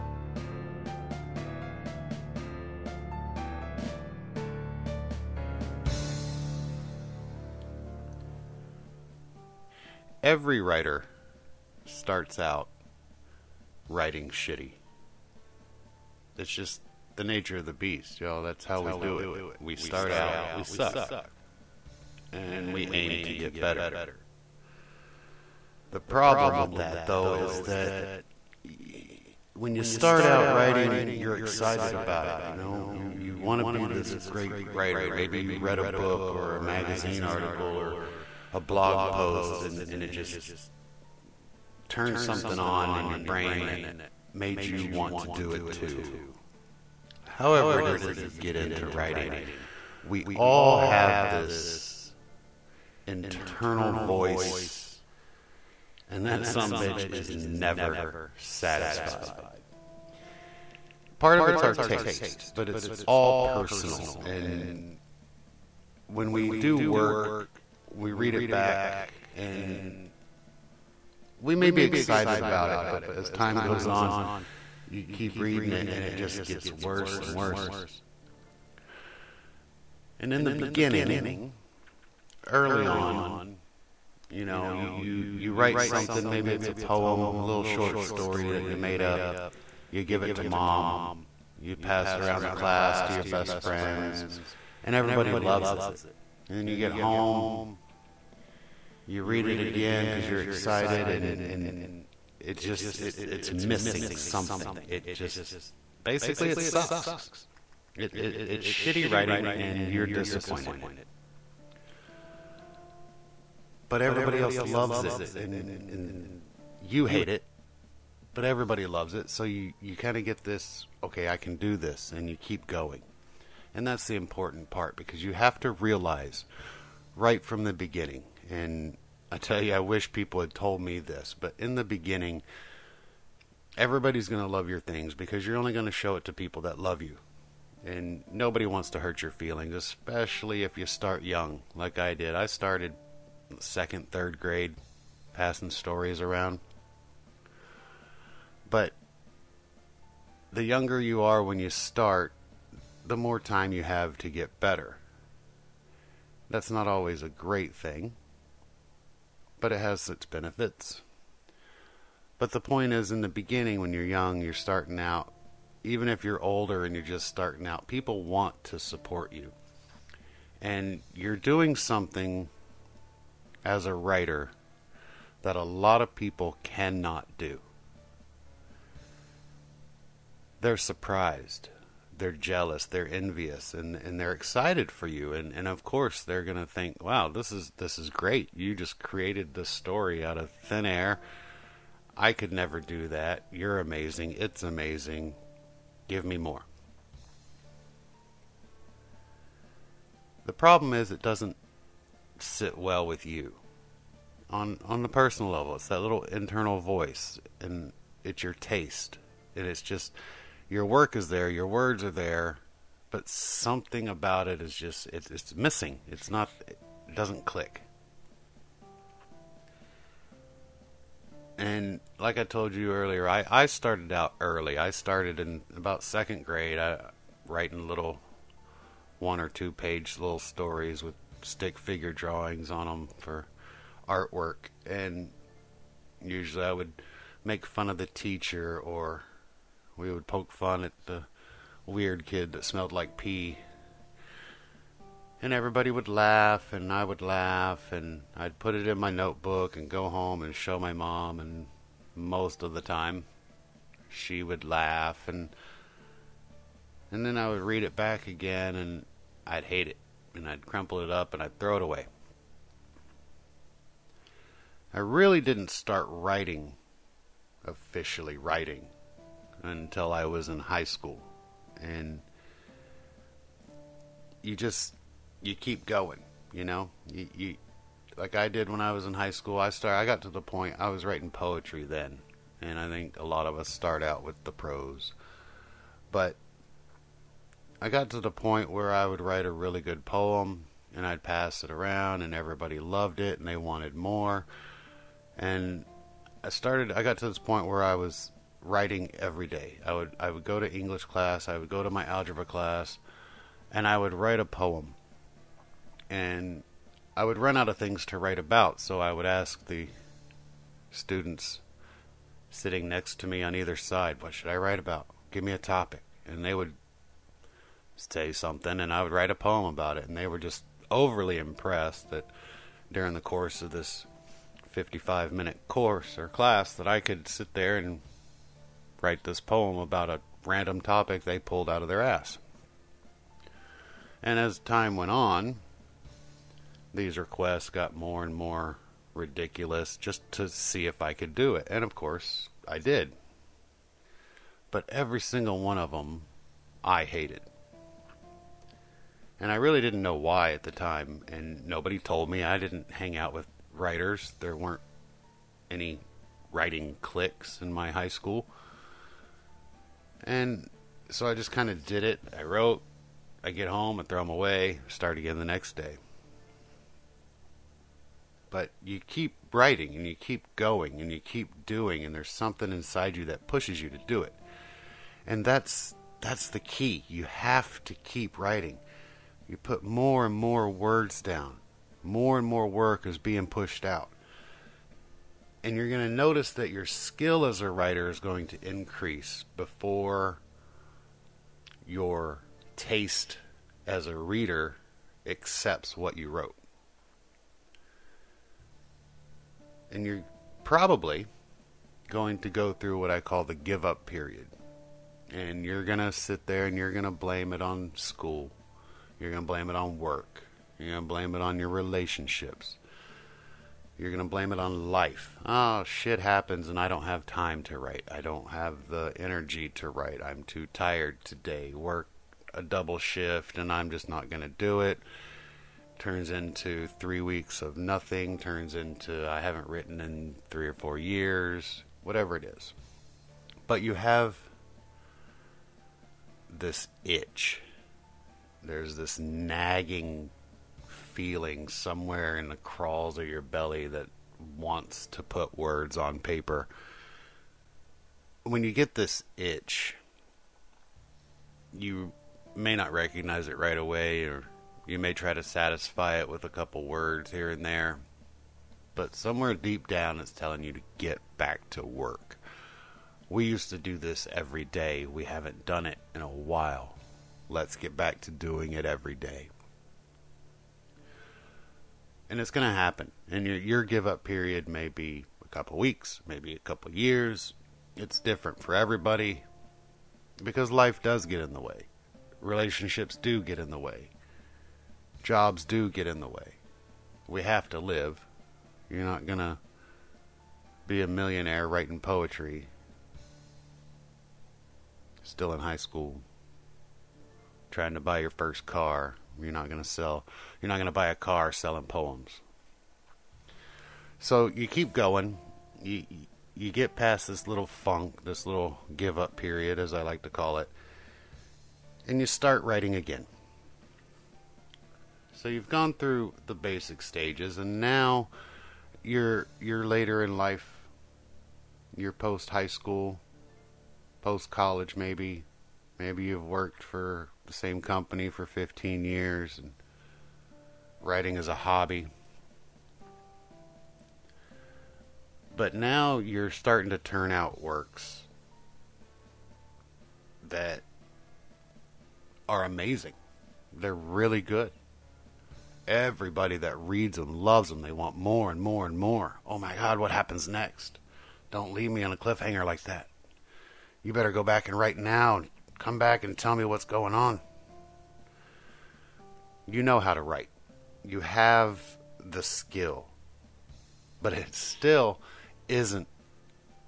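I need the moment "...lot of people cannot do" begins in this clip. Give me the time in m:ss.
2:55.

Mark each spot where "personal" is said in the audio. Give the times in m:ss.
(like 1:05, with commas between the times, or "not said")
1:03, 3:25.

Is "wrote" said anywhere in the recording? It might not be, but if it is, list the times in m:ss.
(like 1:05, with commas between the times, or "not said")
6:02, 6:36.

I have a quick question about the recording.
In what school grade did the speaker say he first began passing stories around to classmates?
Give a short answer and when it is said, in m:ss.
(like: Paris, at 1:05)
second grade, at 3:46.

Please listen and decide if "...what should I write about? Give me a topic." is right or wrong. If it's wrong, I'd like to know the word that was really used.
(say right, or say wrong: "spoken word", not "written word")
right.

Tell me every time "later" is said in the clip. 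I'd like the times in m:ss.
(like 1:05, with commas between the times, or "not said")
8:39.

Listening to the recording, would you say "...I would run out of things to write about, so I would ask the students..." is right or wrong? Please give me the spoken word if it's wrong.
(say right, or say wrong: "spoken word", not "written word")
right.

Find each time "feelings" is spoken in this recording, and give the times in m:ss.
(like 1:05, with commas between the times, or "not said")
2:19, 7:21.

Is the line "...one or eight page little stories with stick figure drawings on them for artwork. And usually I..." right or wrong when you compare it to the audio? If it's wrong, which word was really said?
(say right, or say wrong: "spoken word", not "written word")
wrong: "two", not "eight".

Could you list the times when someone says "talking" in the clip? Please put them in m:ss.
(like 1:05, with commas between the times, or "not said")
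not said.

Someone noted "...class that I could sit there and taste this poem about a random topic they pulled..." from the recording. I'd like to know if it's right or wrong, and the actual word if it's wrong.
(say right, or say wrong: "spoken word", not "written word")
wrong: "write", not "taste".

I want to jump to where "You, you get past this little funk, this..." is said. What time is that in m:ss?
8:25.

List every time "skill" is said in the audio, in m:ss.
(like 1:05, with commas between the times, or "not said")
6:26, 9:22.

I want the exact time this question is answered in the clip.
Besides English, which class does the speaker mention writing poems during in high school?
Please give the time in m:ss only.
5:02.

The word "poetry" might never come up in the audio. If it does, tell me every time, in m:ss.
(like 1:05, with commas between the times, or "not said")
4:41, 8:11.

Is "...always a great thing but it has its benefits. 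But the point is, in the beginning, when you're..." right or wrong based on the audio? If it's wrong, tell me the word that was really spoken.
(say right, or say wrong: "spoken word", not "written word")
right.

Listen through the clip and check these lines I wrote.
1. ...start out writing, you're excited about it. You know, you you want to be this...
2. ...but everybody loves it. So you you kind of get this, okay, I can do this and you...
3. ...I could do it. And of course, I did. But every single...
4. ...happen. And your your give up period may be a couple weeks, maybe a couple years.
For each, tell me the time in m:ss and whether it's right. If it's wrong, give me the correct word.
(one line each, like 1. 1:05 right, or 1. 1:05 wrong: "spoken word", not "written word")
1. 0:29 right
2. 1:58 right
3. 5:41 right
4. 7:52 right.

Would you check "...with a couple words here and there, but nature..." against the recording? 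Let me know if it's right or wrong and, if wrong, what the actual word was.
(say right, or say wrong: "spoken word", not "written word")
wrong: "somewhere", not "nature".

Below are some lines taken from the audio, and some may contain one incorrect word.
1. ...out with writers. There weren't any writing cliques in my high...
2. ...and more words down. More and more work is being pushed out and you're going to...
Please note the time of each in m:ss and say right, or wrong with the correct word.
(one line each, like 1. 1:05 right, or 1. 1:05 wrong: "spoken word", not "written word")
1. 5:53 right
2. 6:20 right.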